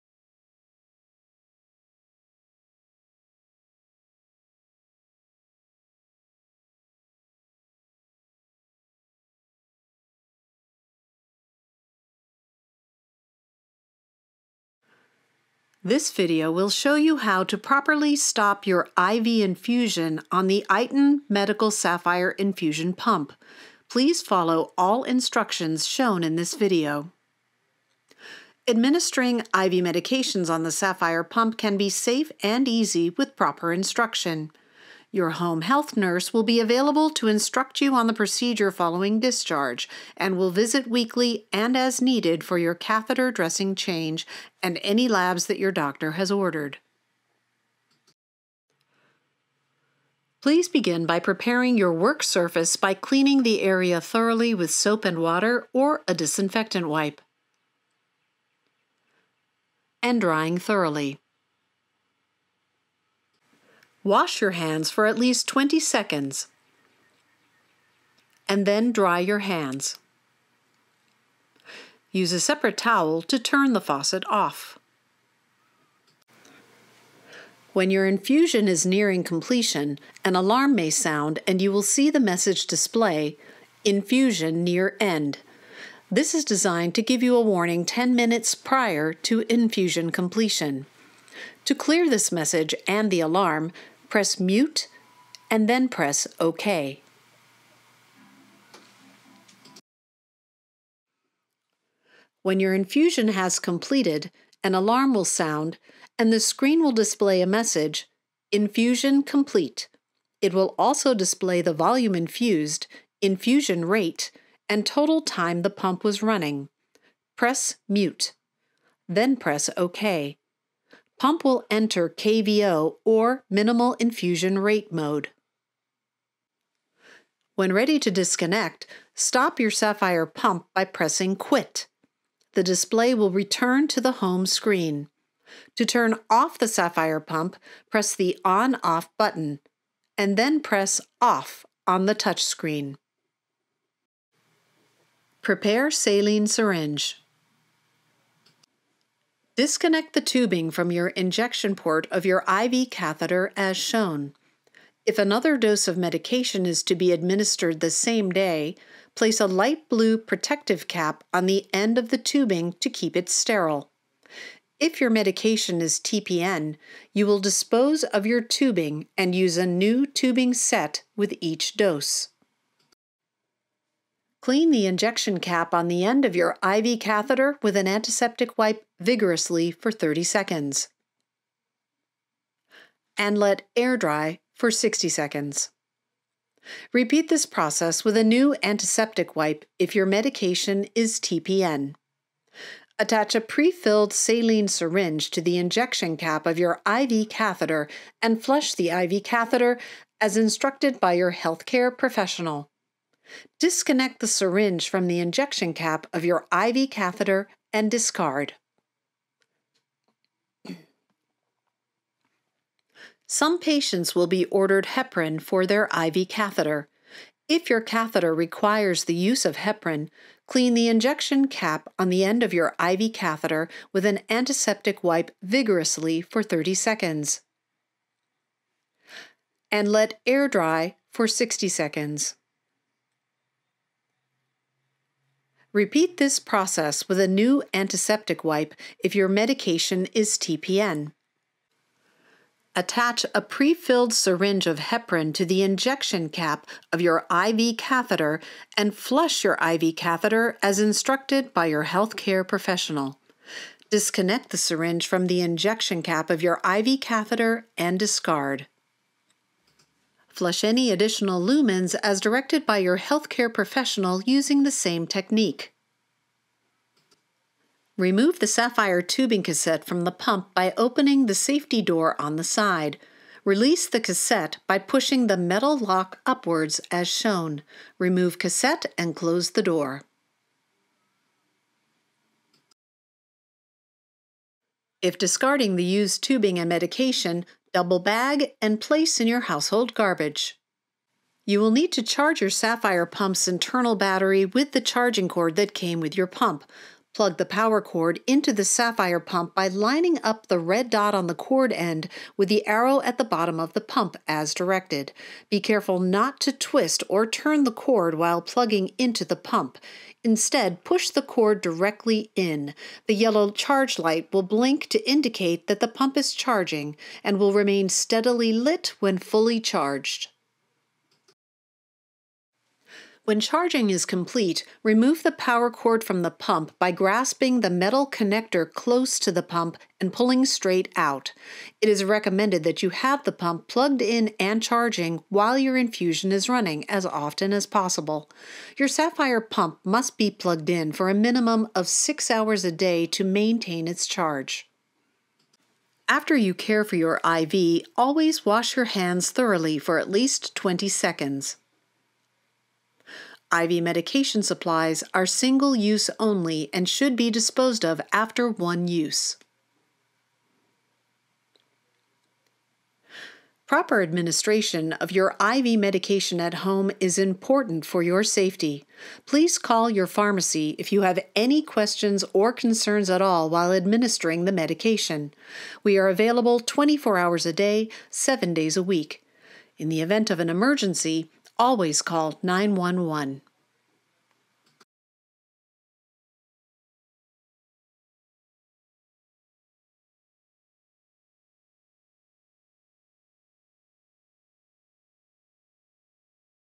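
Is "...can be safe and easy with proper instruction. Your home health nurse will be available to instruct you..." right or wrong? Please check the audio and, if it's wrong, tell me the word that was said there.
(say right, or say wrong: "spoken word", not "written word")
right.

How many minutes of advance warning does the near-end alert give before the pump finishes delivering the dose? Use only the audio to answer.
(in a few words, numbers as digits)
10.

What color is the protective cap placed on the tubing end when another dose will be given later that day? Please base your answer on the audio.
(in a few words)
light blue.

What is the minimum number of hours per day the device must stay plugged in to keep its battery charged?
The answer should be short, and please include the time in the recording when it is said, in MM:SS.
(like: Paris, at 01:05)
6, at 05:41.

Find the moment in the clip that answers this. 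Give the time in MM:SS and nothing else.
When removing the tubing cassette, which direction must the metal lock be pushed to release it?
04:36.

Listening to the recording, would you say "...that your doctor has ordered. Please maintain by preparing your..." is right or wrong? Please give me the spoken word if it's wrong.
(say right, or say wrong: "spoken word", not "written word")
wrong: "begin", not "maintain".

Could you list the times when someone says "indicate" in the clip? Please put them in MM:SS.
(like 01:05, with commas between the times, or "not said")
05:15.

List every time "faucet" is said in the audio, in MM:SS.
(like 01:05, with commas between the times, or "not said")
01:13.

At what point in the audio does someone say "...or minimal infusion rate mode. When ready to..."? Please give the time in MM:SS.
02:03.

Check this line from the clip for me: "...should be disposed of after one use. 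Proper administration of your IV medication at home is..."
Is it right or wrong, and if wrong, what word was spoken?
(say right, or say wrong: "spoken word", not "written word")
right.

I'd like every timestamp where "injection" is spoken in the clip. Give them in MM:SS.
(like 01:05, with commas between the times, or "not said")
02:31, 02:54, 03:15, 03:25, 03:40, 04:05, 04:15.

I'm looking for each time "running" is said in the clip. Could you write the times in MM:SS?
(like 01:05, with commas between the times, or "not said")
01:56, 05:36.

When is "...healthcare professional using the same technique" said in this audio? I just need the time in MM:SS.
04:22.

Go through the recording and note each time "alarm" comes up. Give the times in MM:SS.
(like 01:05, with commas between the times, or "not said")
01:20, 01:33, 01:44.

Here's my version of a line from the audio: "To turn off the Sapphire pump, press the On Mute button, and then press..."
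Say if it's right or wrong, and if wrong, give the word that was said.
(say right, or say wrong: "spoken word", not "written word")
wrong: "Off", not "Mute".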